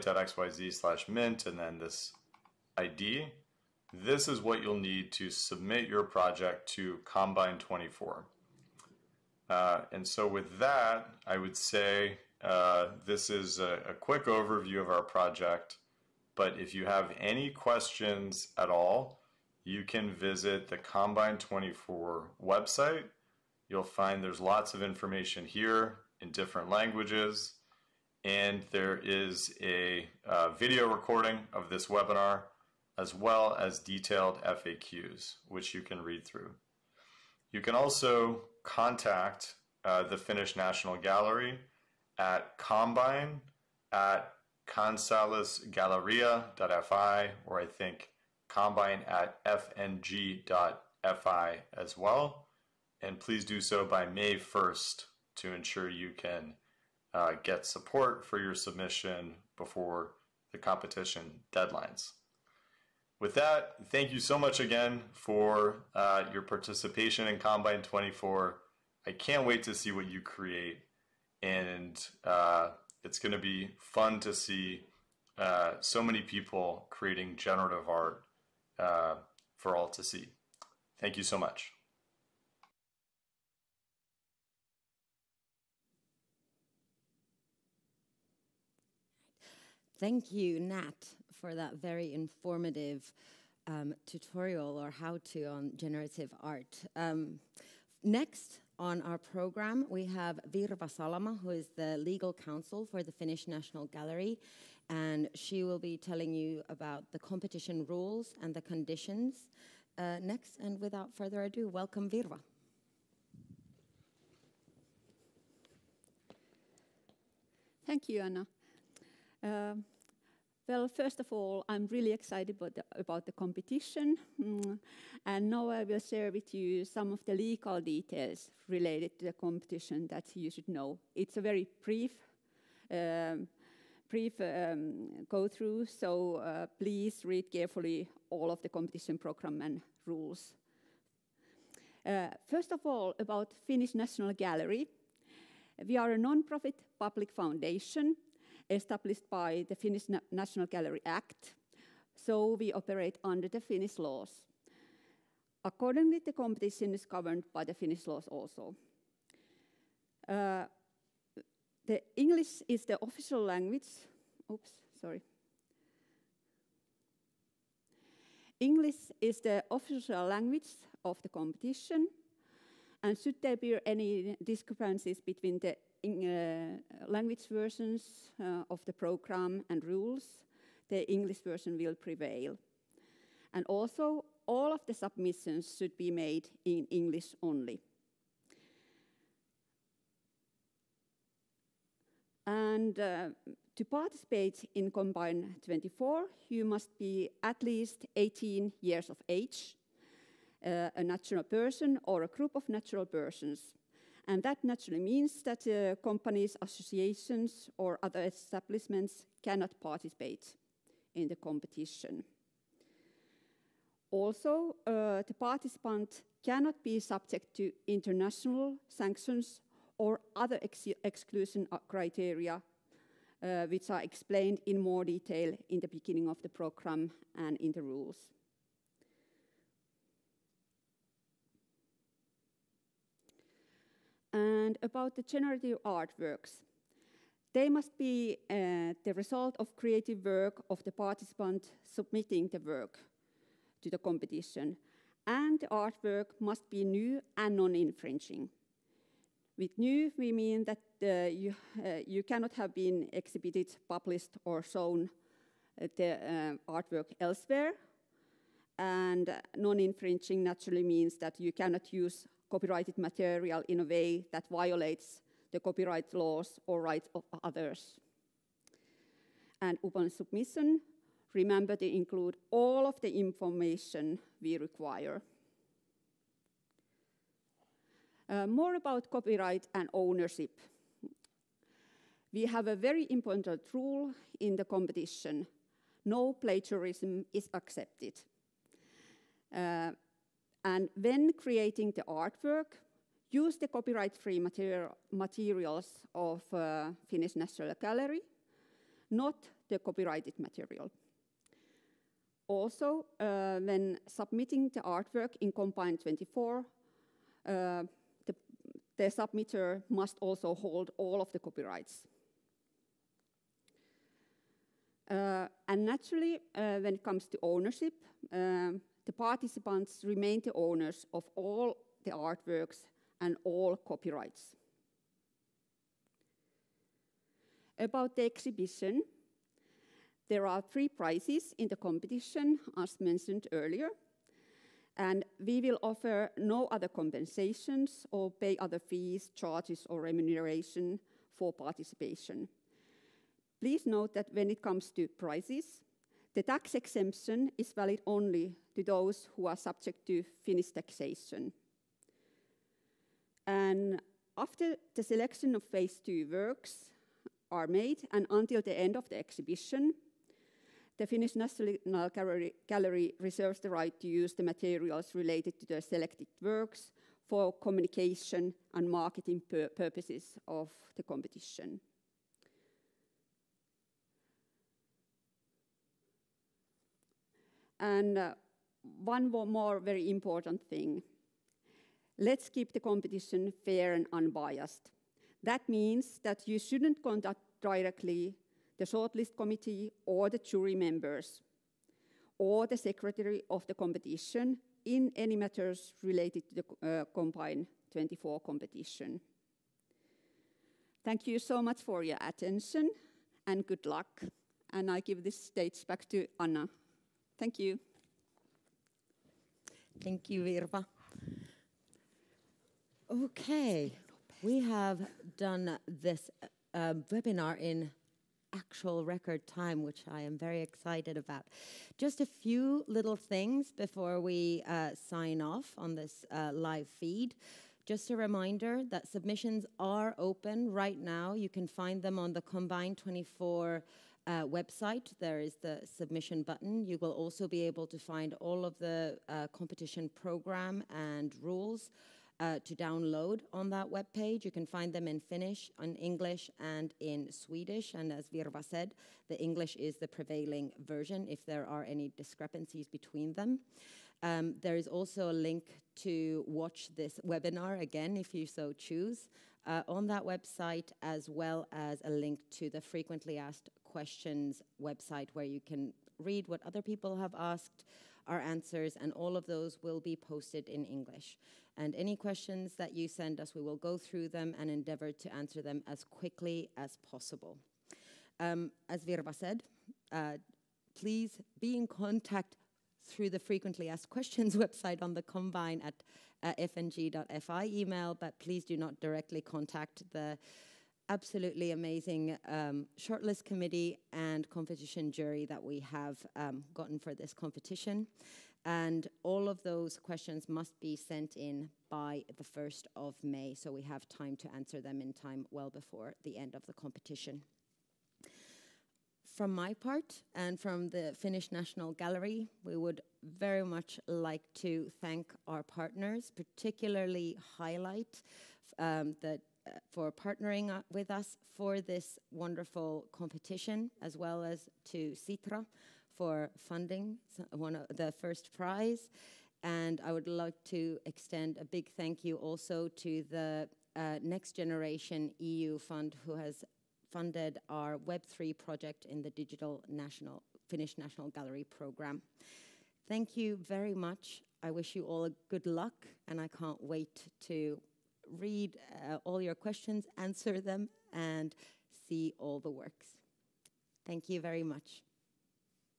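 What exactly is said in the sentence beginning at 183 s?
And also, all of the submissions should be made in English only.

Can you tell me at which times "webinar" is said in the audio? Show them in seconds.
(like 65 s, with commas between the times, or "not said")
31 s, 417 s, 457 s.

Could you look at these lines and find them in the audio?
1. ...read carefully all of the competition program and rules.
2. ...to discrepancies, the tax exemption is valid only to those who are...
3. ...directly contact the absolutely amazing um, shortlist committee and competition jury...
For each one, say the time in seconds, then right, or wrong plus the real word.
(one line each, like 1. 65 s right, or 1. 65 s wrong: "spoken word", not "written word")
1. 137 s right
2. 344 s wrong: "prices", not "discrepancies"
3. 489 s right.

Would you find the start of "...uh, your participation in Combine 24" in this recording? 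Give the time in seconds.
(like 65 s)
65 s.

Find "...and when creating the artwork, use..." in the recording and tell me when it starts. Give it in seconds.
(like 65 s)
290 s.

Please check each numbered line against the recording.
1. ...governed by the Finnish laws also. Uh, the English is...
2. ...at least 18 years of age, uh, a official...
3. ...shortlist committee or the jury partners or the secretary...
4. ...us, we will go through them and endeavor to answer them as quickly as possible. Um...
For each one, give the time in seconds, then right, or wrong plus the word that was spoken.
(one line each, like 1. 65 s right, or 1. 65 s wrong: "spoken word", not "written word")
1. 157 s right
2. 197 s wrong: "natural", not "official"
3. 388 s wrong: "members", not "partners"
4. 473 s right.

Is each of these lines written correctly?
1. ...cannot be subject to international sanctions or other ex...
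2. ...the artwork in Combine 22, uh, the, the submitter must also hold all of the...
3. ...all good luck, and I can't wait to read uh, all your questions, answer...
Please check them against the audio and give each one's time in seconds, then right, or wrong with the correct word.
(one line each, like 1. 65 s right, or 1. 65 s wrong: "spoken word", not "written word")
1. 216 s right
2. 304 s wrong: "24", not "22"
3. 545 s right.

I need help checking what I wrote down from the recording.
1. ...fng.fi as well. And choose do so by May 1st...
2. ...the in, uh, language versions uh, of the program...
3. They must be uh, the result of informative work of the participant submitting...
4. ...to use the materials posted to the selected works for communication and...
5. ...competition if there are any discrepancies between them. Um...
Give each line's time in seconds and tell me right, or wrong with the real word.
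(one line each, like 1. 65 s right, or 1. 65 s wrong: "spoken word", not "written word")
1. 49 s wrong: "please", not "choose"
2. 175 s right
3. 237 s wrong: "creative", not "informative"
4. 364 s wrong: "related", not "posted"
5. 450 s wrong: "version", not "competition".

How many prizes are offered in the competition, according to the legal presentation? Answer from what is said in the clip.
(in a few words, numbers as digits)
3.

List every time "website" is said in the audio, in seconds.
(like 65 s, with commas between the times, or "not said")
22 s, 434 s, 460 s, 464 s, 484 s.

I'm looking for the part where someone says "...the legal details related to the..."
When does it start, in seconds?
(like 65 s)
127 s.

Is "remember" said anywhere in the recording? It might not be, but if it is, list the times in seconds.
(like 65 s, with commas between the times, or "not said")
271 s.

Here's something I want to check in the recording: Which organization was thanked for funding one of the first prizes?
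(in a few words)
Sitra.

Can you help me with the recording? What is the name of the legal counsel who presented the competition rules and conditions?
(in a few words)
Virva Salama.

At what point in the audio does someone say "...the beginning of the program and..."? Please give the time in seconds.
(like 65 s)
225 s.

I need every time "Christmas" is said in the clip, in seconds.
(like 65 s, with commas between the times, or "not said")
not said.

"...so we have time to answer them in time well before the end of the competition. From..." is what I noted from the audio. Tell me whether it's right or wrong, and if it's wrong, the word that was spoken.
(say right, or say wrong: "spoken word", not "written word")
right.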